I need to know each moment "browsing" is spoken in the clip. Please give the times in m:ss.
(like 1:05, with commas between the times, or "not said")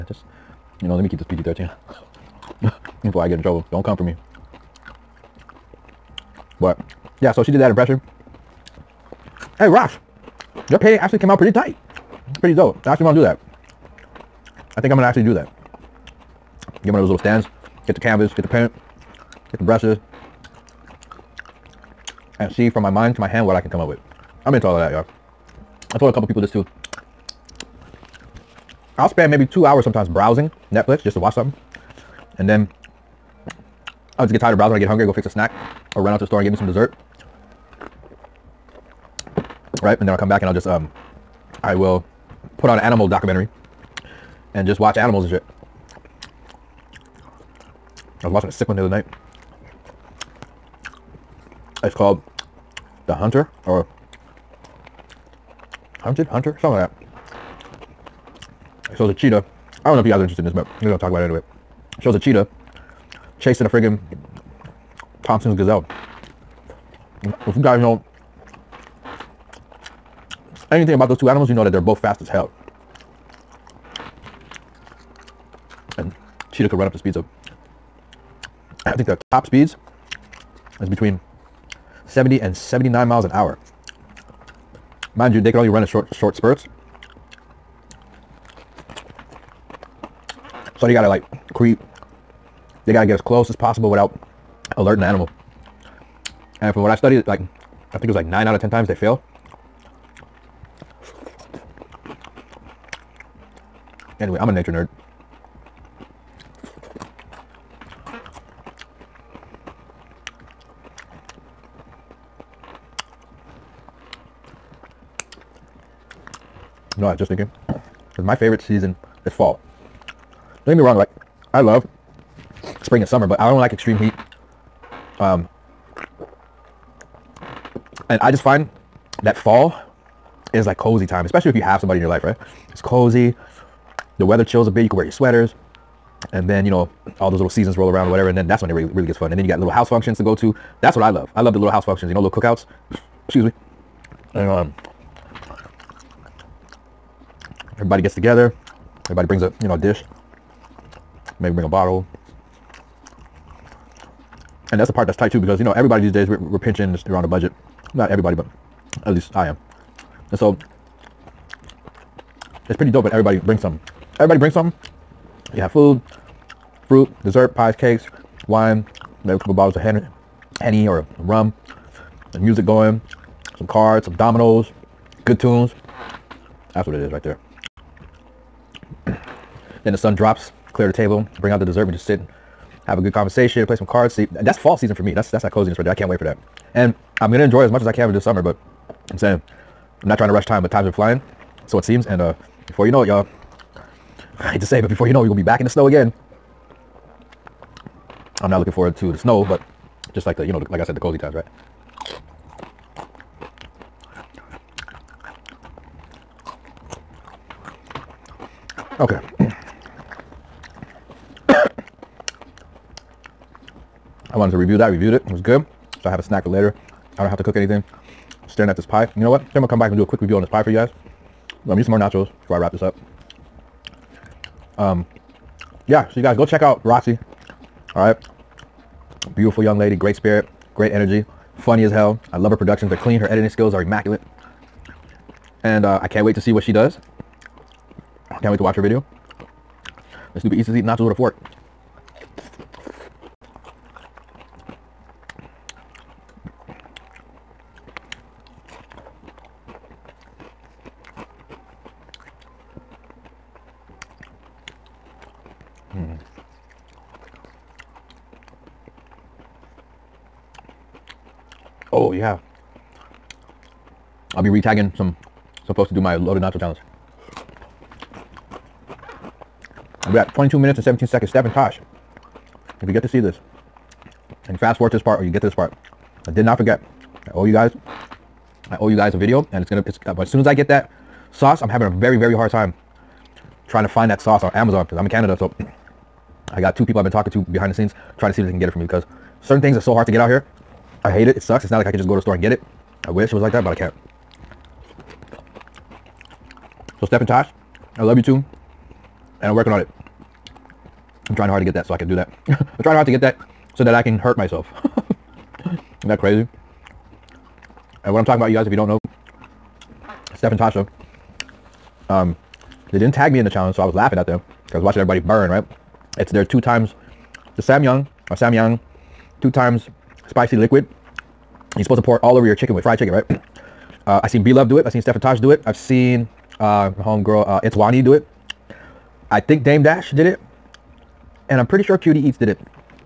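0:30, 0:34.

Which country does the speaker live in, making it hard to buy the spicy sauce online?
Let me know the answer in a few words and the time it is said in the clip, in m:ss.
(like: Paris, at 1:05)
Canada, at 4:45.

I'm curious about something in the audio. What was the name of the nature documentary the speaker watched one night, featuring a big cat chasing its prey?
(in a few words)
The Hunter.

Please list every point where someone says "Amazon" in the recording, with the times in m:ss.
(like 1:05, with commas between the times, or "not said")
4:44.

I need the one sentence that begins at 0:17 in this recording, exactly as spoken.
Get the canvas, get the paint, get the brushes.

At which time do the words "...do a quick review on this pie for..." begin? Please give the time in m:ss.
3:39.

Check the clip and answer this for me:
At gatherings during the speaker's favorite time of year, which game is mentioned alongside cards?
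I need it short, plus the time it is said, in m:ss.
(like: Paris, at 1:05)
dominoes, at 2:54.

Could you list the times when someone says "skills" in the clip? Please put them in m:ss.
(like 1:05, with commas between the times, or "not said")
3:53.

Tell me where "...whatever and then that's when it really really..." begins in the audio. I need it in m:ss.
2:18.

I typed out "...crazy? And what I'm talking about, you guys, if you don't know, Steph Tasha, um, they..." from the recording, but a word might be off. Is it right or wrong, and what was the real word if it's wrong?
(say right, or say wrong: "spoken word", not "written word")
right.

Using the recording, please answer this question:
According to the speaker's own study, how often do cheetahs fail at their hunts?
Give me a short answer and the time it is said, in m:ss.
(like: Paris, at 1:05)
9 out of 10 times, at 1:38.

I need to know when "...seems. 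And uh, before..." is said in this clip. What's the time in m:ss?
3:11.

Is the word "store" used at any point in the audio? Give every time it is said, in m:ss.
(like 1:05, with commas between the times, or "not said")
0:36, 4:52.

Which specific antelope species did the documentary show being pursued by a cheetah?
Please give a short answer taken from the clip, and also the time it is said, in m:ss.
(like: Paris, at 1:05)
Thompson's gazelle, at 1:05.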